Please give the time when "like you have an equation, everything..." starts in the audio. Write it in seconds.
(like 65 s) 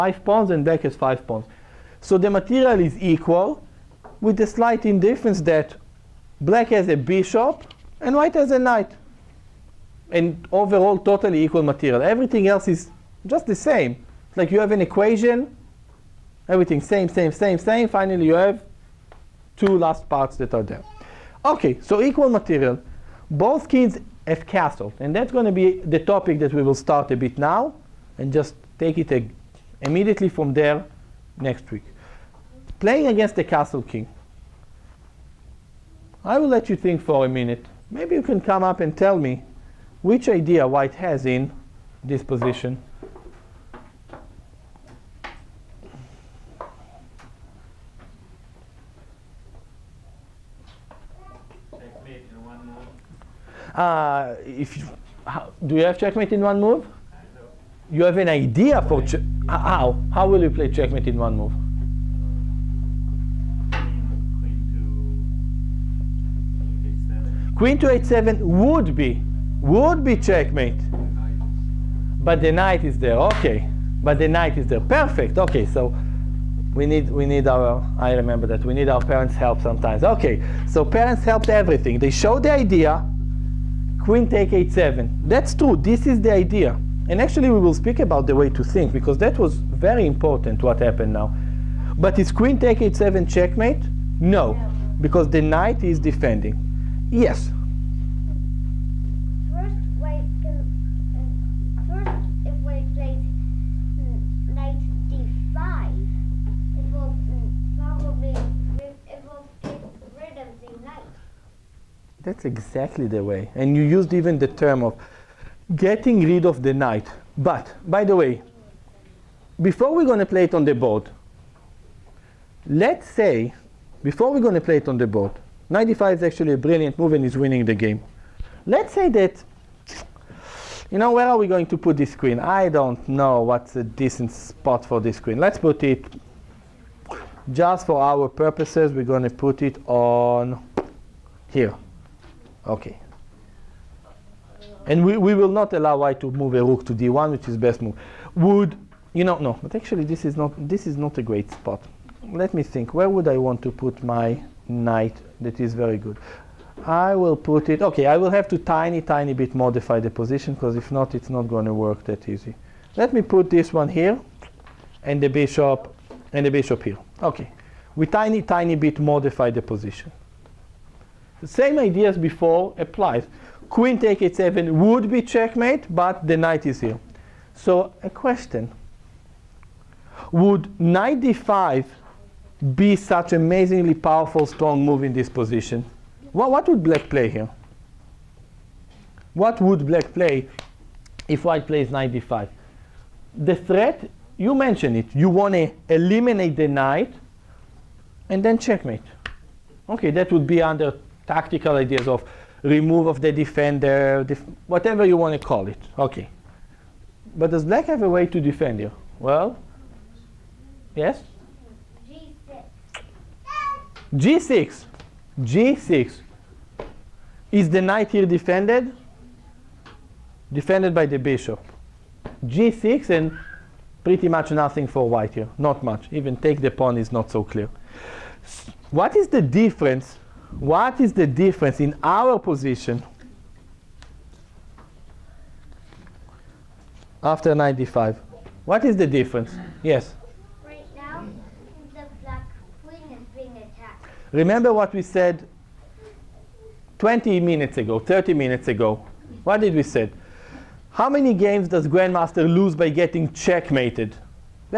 14 s.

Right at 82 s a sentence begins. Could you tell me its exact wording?
They showed the idea, queen take h7.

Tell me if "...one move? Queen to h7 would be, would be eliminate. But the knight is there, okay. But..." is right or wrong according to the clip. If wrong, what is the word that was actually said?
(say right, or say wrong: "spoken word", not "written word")
wrong: "checkmate", not "eliminate".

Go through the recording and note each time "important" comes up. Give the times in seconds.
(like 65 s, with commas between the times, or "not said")
90 s.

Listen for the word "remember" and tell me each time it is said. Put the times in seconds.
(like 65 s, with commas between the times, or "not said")
78 s, 244 s.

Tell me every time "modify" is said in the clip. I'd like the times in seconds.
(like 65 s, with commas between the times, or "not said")
159 s, 168 s.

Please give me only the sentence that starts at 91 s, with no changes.
But is queen take h7 checkmate?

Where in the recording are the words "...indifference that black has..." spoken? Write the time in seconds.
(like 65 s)
4 s.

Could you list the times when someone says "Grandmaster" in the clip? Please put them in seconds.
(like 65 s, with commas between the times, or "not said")
251 s.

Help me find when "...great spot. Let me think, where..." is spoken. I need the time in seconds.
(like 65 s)
151 s.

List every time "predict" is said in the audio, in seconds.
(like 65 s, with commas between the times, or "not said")
not said.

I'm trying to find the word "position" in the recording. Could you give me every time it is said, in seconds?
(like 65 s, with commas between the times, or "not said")
42 s, 160 s, 169 s, 185 s, 232 s.